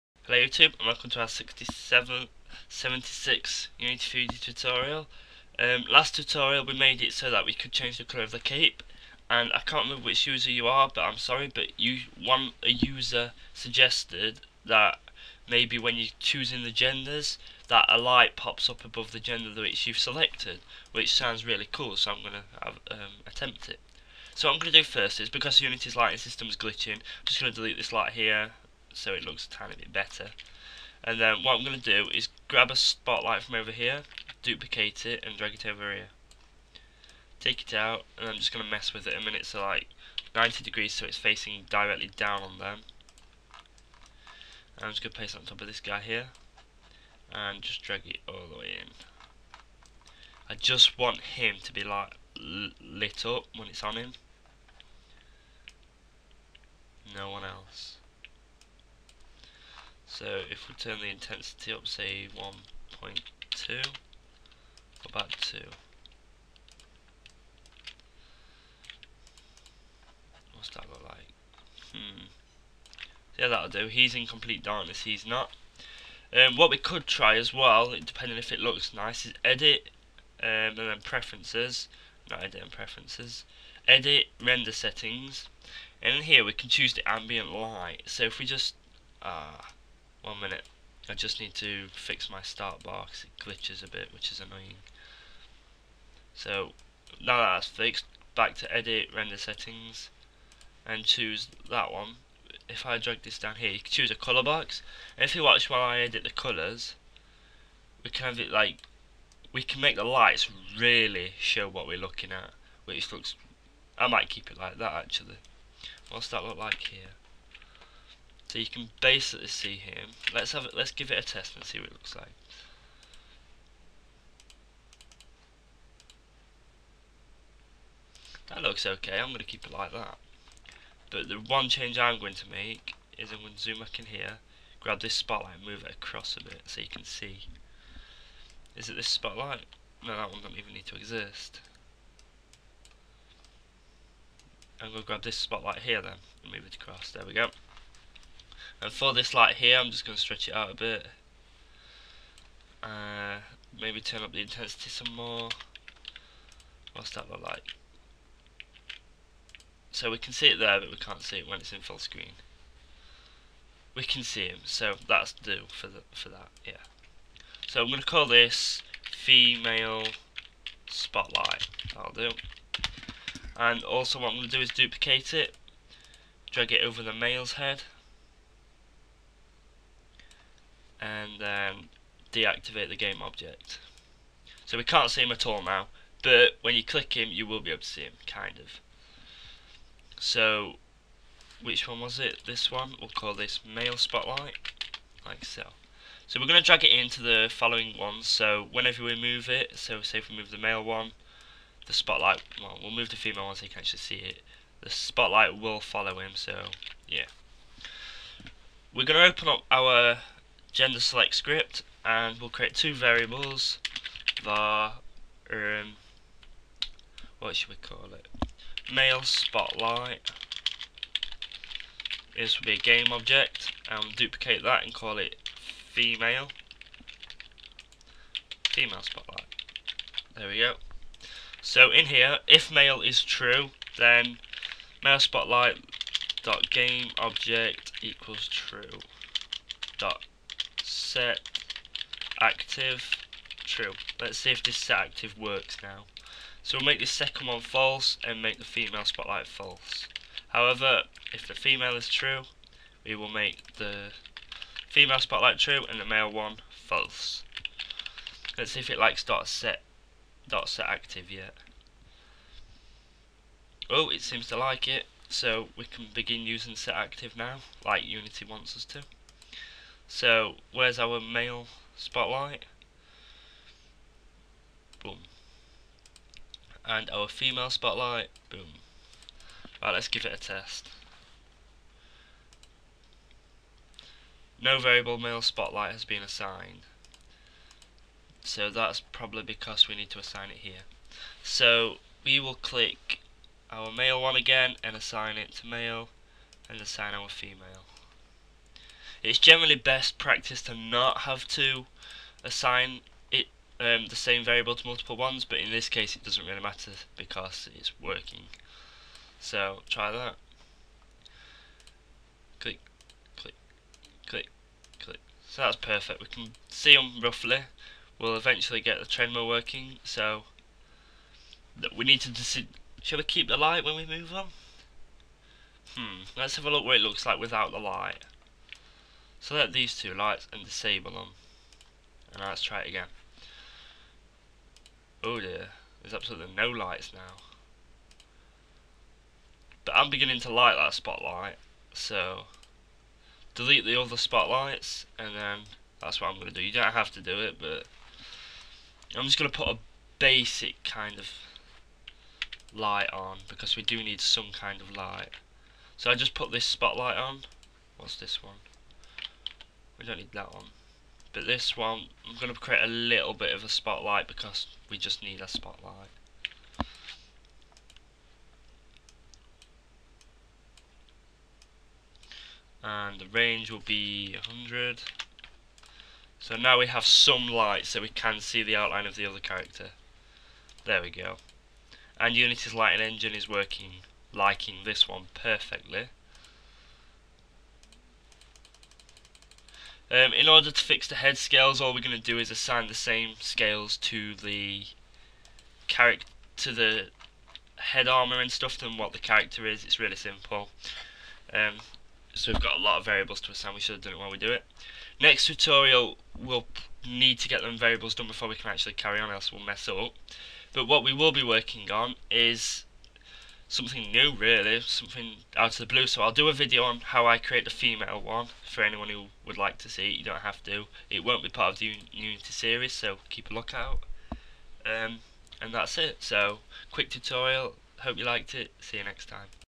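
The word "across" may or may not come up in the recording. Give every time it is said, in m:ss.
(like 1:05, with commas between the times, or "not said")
2:15, 2:26.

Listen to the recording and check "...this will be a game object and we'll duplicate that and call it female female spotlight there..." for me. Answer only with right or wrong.
right.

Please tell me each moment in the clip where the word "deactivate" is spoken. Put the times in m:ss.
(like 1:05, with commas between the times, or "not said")
3:02.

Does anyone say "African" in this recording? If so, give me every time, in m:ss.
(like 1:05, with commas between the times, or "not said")
not said.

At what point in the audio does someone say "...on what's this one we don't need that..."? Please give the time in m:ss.
5:57.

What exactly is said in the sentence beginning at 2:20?
No, that one doesn't even need to exist.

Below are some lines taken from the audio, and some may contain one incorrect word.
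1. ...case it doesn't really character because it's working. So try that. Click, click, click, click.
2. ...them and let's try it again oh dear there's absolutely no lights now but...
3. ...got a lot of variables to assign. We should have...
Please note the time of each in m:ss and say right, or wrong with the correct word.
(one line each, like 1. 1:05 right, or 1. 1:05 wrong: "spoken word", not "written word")
1. 5:05 wrong: "matter", not "character"
2. 5:31 right
3. 6:42 right.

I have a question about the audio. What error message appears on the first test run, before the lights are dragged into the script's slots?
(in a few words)
No variable male spotlight has been assigned.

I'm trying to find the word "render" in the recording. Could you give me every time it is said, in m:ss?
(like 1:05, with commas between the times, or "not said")
1:24, 1:39.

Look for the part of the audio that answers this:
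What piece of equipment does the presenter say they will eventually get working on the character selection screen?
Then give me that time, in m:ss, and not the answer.
5:19.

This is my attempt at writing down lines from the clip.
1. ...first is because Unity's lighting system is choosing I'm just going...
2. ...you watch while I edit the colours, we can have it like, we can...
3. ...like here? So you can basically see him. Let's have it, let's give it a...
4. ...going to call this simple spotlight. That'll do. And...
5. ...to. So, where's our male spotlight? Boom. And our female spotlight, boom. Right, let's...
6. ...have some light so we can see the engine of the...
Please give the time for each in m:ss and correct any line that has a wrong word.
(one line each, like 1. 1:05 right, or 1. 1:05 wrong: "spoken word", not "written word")
1. 0:24 wrong: "glitching", not "choosing"
2. 1:45 right
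3. 1:56 right
4. 2:47 wrong: "female", not "simple"
5. 4:28 right
6. 6:16 wrong: "outline", not "engine".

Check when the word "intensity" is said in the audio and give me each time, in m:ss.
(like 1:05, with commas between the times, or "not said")
1:01, 2:34.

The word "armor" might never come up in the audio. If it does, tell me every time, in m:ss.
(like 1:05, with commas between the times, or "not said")
6:38.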